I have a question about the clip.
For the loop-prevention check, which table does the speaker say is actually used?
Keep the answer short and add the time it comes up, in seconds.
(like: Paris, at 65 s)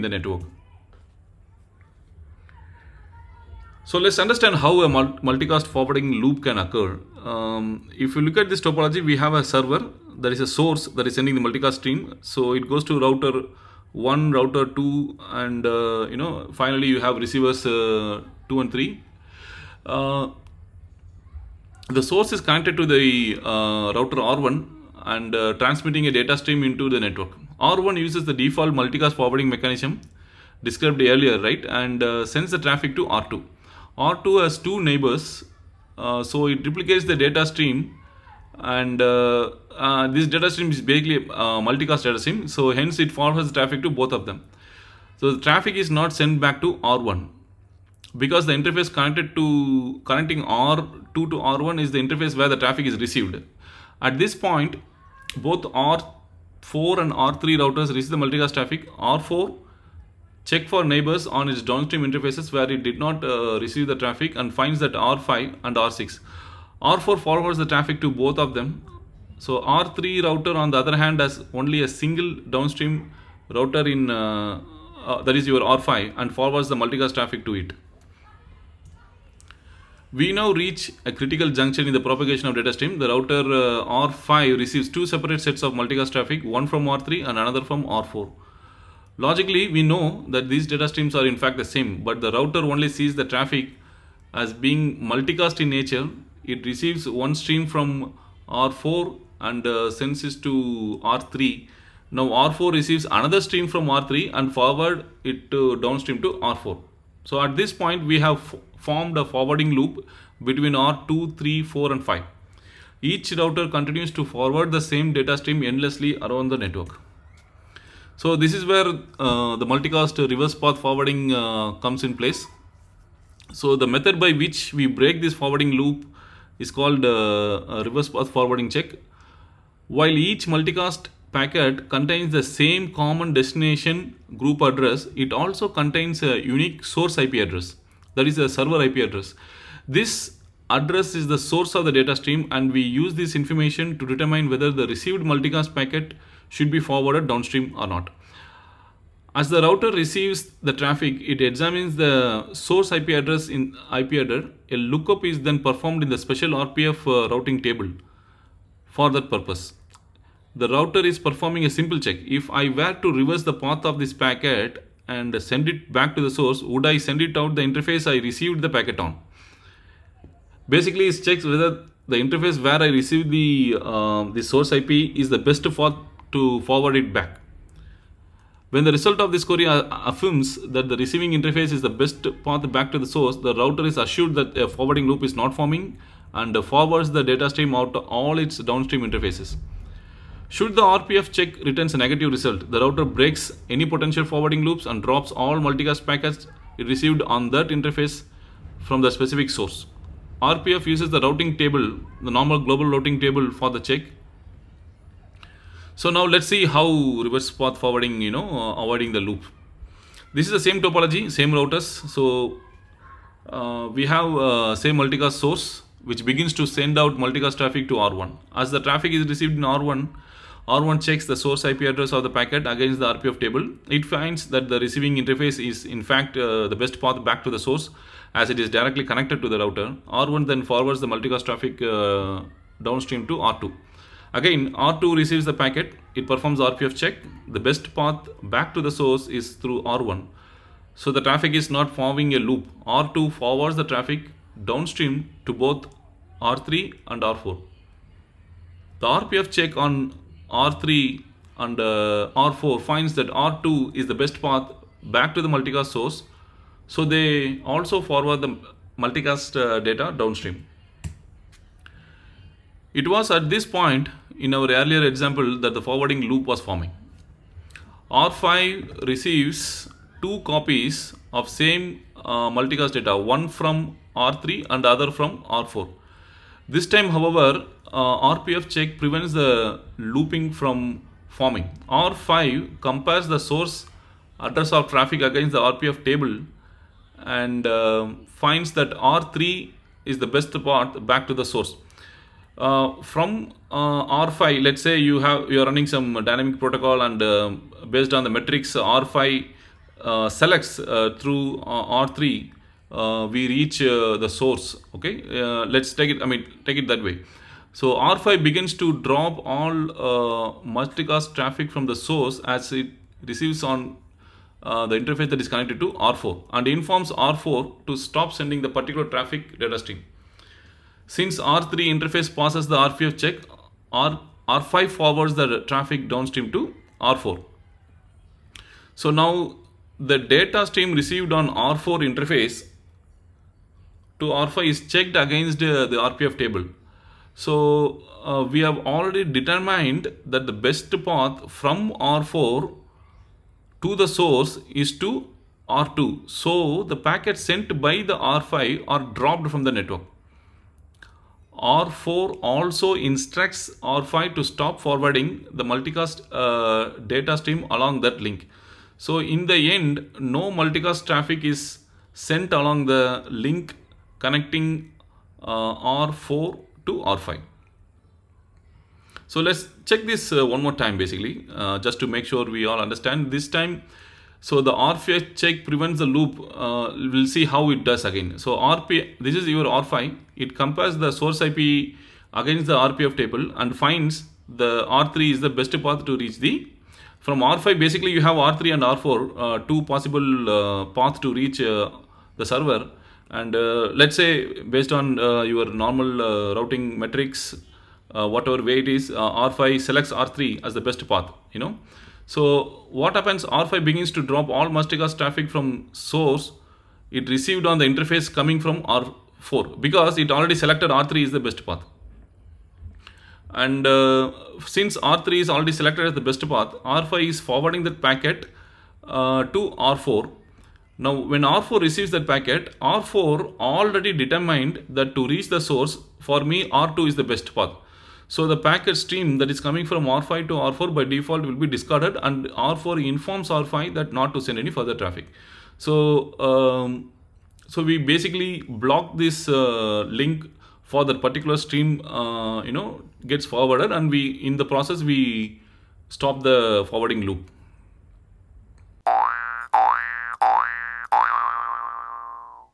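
global routing table, at 202 s.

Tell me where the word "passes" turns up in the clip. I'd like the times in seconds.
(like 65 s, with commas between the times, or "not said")
322 s.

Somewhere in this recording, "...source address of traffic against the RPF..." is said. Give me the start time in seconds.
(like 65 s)
283 s.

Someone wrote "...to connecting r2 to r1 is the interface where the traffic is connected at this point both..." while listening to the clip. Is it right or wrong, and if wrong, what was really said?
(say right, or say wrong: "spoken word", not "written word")
wrong: "received", not "connected".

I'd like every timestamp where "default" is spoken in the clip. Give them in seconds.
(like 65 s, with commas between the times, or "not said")
28 s, 431 s.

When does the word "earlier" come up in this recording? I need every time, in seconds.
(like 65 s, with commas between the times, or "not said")
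31 s, 264 s.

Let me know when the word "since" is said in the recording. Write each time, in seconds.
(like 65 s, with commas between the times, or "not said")
321 s, 414 s.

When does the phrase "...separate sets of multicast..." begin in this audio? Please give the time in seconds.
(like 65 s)
85 s.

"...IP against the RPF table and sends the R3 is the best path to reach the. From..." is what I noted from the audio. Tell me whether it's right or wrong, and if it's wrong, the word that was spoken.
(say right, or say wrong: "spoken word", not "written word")
wrong: "finds", not "sends".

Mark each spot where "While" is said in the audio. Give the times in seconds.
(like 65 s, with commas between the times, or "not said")
129 s.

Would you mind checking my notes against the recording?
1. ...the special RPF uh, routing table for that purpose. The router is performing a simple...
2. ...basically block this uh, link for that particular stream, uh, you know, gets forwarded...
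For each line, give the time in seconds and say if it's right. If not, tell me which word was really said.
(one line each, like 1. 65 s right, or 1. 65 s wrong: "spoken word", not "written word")
1. 156 s right
2. 437 s right.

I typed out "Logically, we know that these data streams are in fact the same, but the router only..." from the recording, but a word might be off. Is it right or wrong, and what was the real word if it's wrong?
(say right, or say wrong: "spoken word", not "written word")
right.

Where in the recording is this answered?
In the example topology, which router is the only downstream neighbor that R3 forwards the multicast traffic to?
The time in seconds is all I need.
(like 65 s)
75 s.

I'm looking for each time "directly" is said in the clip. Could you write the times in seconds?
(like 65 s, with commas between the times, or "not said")
228 s.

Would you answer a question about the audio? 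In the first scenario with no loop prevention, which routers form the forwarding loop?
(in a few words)
R2, 3, 4 and 5.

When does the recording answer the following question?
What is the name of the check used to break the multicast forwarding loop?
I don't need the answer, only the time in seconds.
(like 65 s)
127 s.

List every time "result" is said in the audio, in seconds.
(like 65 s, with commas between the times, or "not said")
178 s, 192 s.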